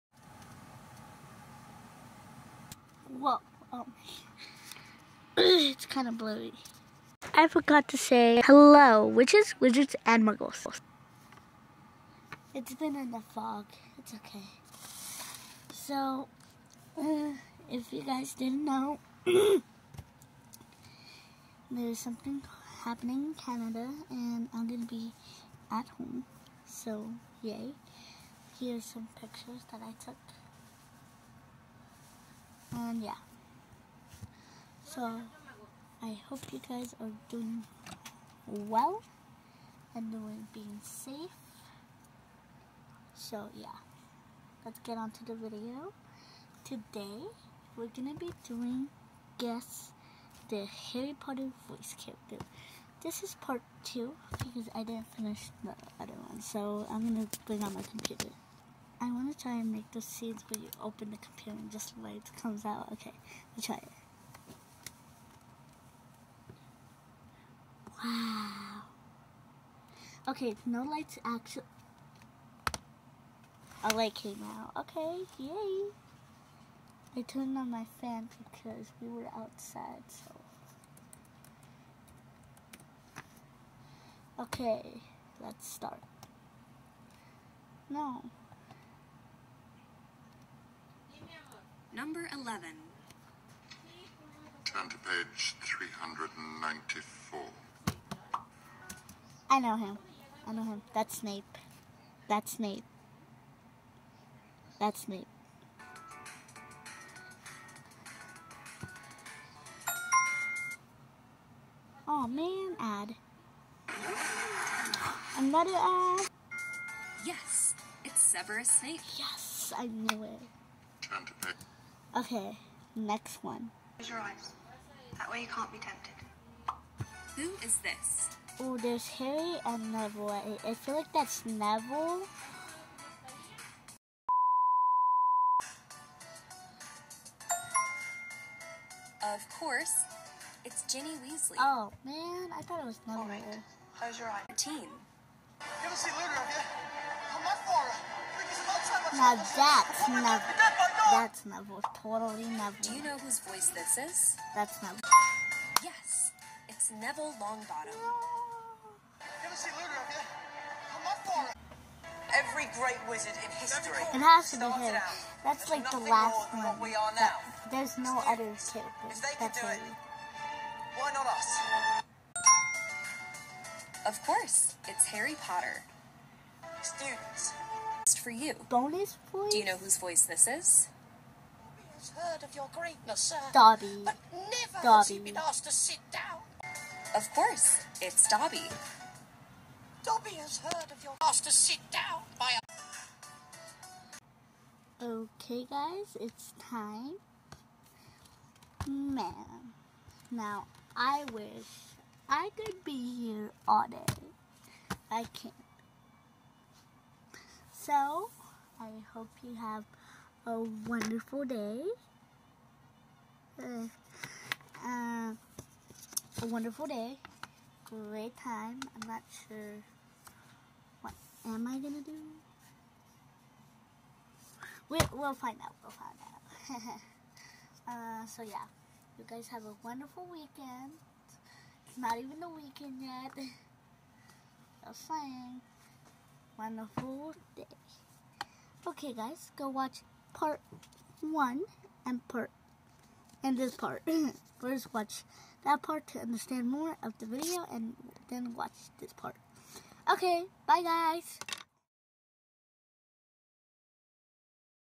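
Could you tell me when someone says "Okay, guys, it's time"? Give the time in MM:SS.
03:15.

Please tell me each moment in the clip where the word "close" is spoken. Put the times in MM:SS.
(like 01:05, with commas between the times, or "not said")
02:03, 02:23.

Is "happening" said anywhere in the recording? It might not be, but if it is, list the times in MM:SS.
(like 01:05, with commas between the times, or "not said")
00:22.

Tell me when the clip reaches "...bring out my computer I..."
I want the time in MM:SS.
00:57.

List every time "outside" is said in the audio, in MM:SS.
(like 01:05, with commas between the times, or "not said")
01:19.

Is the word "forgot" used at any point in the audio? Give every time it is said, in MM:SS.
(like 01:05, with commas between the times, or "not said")
00:07.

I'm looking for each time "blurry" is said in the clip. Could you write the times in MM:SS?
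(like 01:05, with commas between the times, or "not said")
00:06.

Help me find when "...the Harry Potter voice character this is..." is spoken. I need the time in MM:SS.
00:50.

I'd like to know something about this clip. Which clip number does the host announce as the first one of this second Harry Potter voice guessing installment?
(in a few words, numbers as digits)
11.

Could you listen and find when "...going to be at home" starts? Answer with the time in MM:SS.
00:24.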